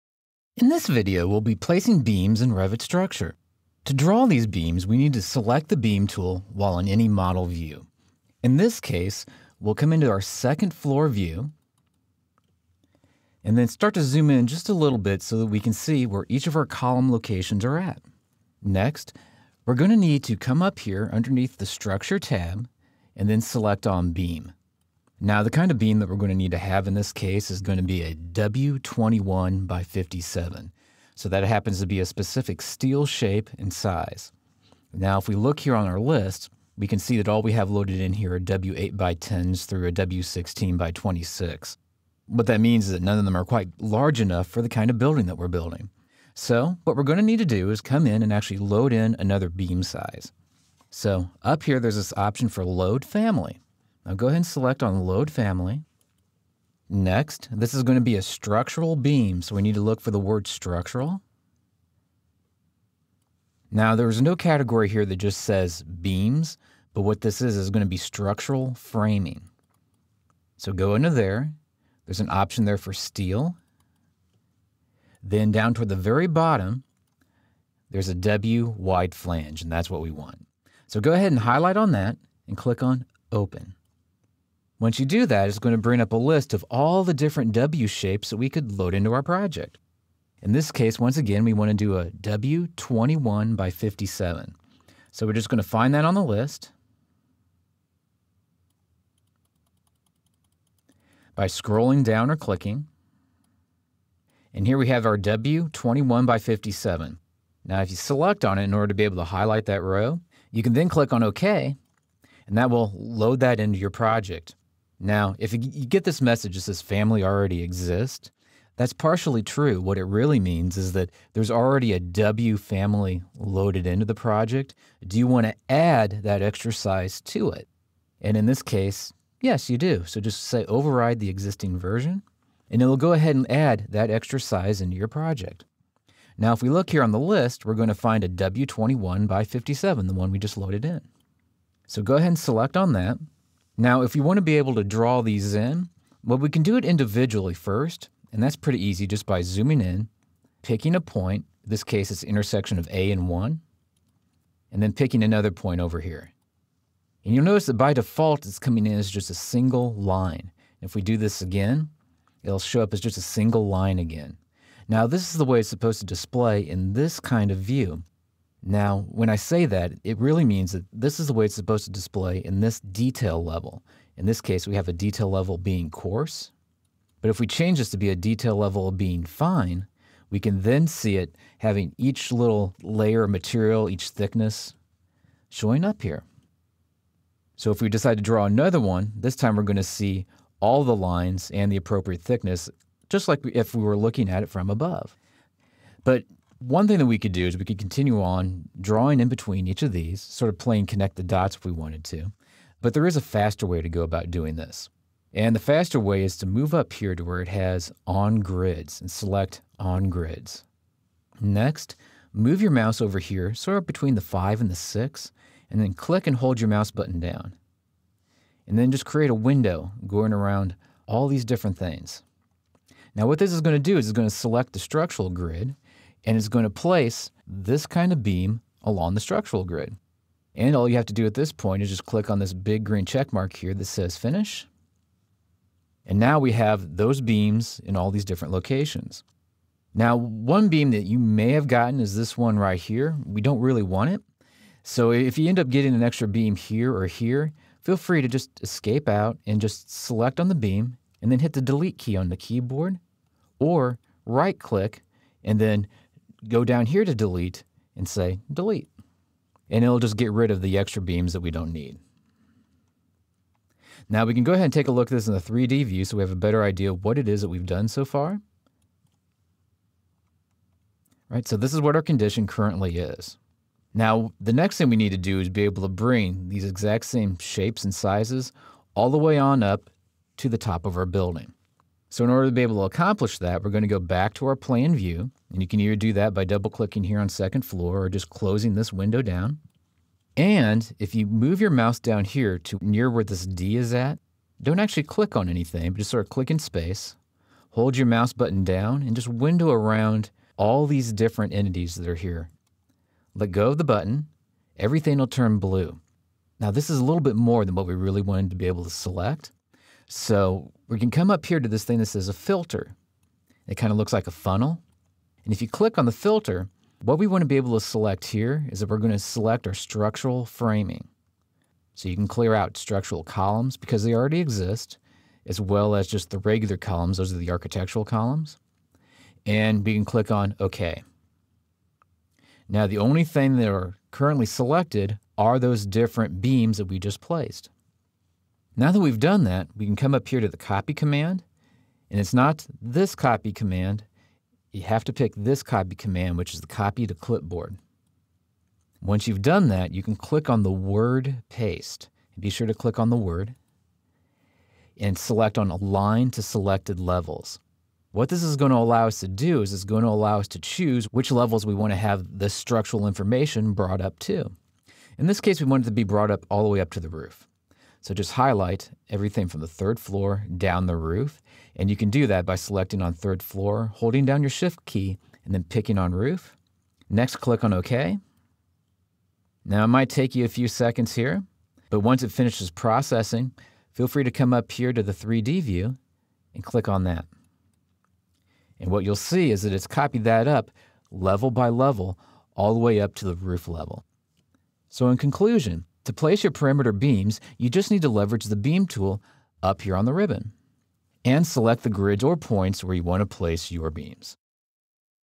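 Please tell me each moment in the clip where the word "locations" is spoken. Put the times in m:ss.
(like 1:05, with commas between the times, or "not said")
0:17, 3:58.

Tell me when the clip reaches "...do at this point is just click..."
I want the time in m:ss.
3:51.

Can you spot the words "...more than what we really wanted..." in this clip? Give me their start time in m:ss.
5:07.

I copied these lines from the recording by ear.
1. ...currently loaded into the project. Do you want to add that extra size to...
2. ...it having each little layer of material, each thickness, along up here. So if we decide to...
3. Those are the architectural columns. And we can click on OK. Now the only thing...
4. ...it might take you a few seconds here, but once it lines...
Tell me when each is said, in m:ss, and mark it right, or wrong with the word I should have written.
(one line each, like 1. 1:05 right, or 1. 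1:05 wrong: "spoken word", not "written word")
1. 2:02 wrong: "family", not "currently"
2. 3:01 wrong: "showing", not "along"
3. 5:27 right
4. 6:19 wrong: "finishes", not "lines".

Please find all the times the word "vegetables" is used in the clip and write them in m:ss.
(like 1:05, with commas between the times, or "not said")
not said.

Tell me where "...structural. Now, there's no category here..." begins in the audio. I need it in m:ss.
1:00.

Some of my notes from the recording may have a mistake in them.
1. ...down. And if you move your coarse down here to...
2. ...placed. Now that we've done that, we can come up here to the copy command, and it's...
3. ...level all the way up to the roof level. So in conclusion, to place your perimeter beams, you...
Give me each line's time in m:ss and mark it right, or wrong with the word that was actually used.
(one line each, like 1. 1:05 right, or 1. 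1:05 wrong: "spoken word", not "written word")
1. 4:49 wrong: "mouse", not "coarse"
2. 5:37 right
3. 6:31 right.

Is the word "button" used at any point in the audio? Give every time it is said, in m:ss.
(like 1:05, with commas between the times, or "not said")
3:36, 4:58, 5:03.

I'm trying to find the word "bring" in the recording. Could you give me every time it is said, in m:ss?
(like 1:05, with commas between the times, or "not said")
1:25, 4:35.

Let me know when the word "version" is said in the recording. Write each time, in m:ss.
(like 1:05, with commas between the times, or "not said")
2:11.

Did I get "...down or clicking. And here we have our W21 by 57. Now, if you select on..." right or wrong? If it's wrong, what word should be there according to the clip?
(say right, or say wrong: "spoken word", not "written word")
right.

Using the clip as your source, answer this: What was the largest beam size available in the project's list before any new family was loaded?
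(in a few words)
W16 by 26.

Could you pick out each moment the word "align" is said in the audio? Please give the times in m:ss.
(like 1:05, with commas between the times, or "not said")
5:55.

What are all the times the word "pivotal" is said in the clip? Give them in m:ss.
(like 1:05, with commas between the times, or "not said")
not said.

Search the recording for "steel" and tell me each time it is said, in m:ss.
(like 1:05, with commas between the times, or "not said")
0:32, 1:12.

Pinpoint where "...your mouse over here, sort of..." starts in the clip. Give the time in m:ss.
3:32.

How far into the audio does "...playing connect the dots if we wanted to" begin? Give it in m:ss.
3:20.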